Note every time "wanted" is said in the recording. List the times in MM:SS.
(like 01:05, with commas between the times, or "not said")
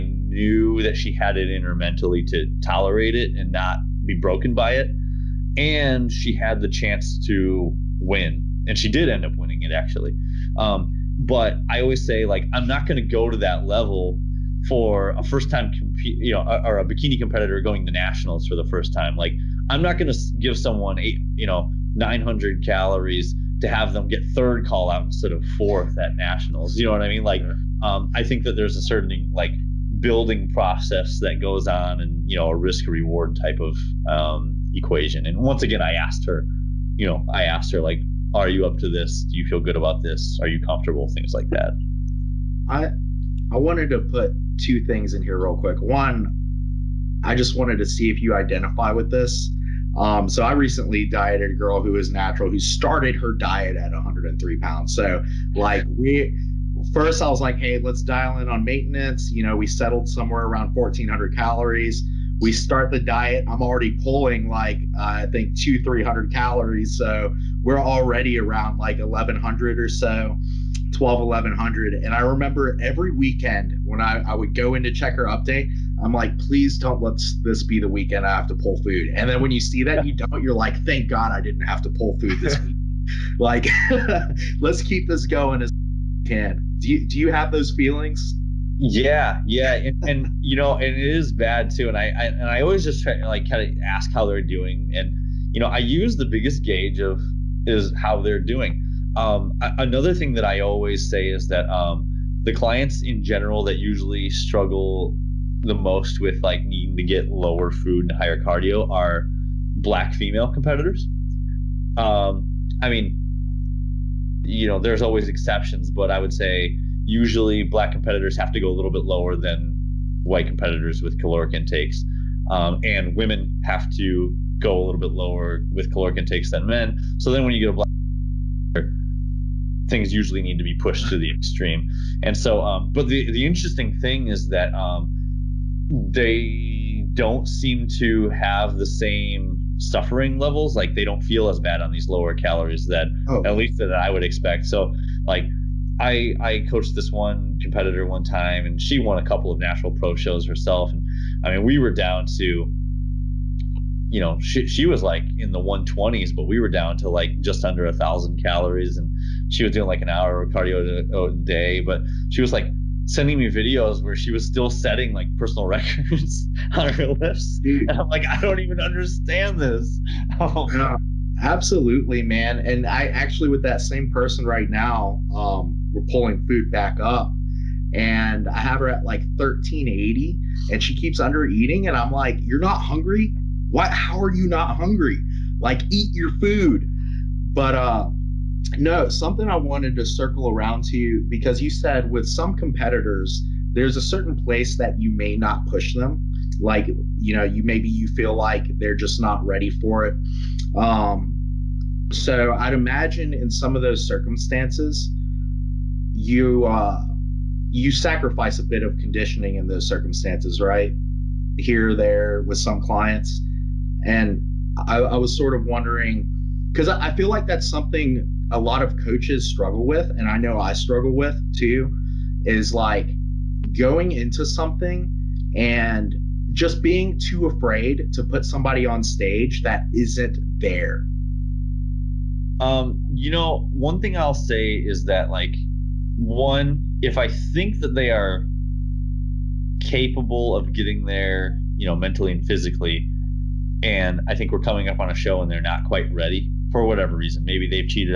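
00:43, 00:47, 03:09.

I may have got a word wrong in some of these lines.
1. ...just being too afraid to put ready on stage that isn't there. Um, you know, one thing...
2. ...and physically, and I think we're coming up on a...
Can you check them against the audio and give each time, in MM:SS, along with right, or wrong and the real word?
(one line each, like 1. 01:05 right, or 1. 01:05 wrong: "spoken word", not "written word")
1. 03:46 wrong: "somebody", not "ready"
2. 04:02 right.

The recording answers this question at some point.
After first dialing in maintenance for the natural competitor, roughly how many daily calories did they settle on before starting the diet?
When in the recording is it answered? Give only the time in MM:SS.
01:00.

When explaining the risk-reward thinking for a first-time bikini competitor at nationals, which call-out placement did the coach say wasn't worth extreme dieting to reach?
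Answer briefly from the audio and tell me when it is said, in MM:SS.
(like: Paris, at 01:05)
Third call out, at 00:24.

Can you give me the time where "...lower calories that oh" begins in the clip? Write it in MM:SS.
02:22.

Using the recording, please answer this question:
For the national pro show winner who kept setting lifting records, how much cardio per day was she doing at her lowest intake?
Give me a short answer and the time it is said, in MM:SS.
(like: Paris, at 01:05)
An hour, at 02:40.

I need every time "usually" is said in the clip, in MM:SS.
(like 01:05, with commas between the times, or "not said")
01:43, 01:57, 02:10.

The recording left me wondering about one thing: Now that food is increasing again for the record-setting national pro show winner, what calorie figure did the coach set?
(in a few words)
1380.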